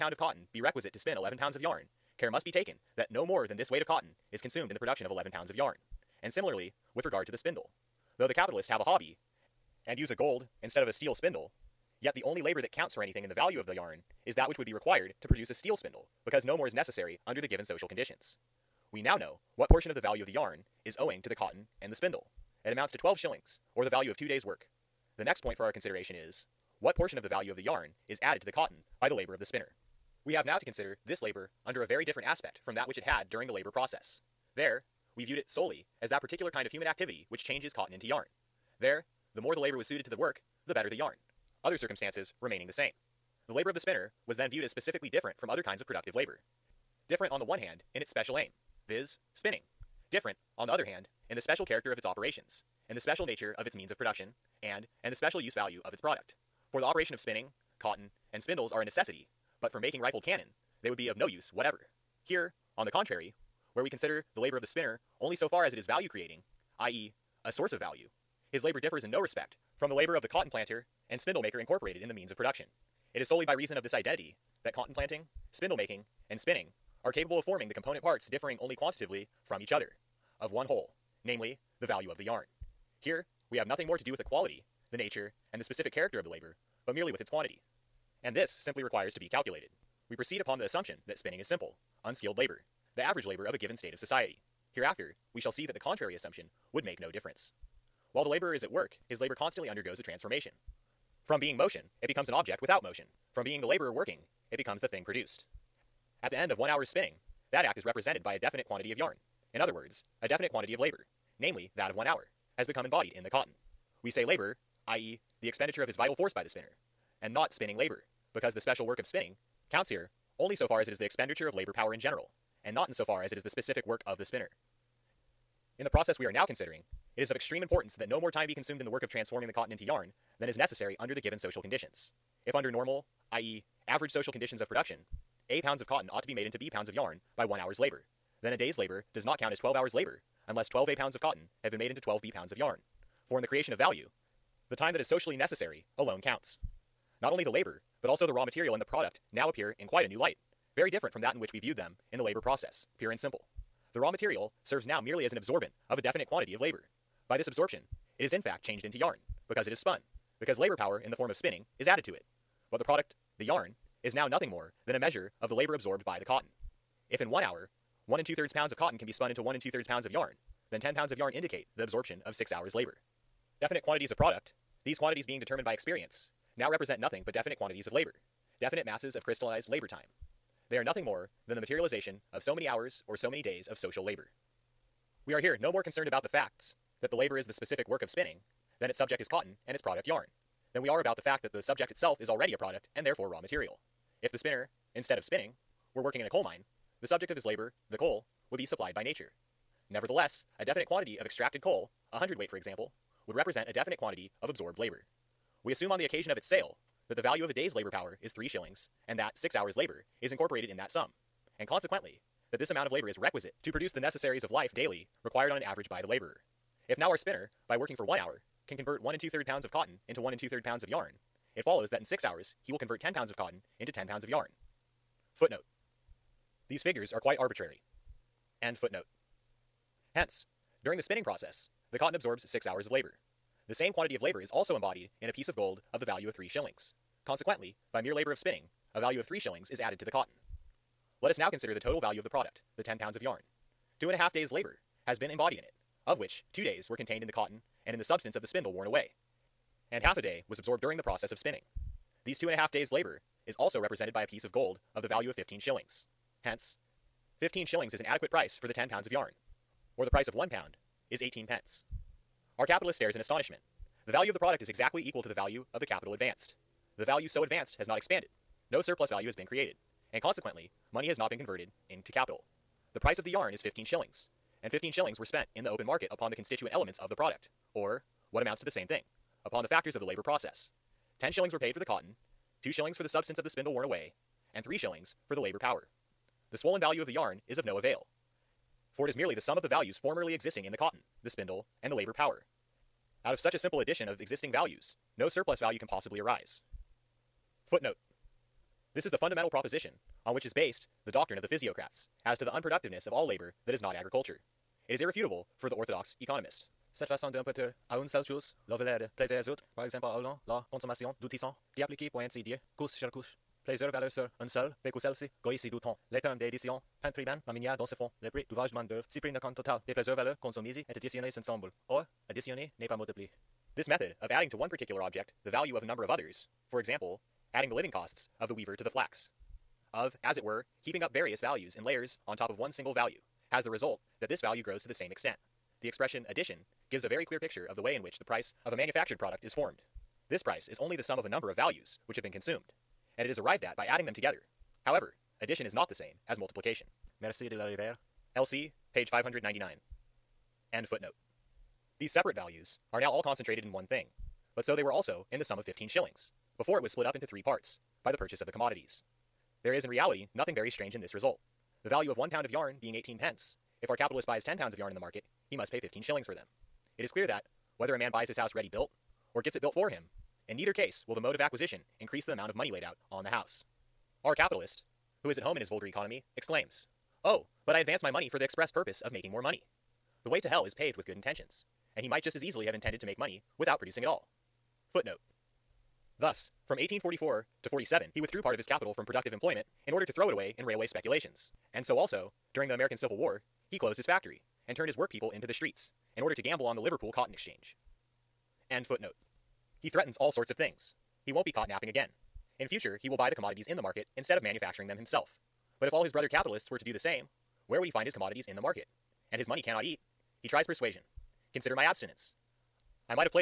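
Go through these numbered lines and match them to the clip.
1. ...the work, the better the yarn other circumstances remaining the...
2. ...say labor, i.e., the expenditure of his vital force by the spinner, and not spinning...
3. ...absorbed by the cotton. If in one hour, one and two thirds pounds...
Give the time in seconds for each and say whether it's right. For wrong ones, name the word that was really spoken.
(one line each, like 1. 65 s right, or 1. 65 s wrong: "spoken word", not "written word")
1. 40 s right
2. 114 s right
3. 165 s right.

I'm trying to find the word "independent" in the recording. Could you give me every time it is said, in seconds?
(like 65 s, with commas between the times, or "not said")
not said.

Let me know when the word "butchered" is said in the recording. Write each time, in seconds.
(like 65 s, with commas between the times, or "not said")
not said.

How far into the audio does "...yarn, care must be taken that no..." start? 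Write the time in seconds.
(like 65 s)
1 s.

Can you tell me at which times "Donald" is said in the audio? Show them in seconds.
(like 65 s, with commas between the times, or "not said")
not said.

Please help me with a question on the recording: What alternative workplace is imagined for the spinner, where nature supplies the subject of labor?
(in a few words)
A coal mine.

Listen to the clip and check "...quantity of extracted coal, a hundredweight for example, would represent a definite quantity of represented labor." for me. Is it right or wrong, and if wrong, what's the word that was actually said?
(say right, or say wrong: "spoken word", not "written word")
wrong: "absorbed", not "represented".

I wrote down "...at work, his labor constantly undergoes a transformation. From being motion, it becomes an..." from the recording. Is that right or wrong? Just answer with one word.
right.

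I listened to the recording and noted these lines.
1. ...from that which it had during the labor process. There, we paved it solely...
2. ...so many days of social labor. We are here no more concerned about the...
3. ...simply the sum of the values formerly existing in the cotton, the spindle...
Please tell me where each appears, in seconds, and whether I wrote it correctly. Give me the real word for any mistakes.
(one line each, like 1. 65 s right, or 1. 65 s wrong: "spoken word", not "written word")
1. 32 s wrong: "viewed", not "paved"
2. 183 s right
3. 289 s wrong: "merely", not "simply".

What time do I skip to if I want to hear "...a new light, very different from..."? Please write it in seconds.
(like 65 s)
150 s.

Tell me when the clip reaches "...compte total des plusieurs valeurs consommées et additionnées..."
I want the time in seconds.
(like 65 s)
319 s.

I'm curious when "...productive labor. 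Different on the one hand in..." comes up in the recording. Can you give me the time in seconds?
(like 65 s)
45 s.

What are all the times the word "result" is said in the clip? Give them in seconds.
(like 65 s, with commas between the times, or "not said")
333 s, 361 s.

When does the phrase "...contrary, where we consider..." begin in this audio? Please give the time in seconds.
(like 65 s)
62 s.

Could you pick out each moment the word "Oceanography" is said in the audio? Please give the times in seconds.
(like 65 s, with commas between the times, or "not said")
not said.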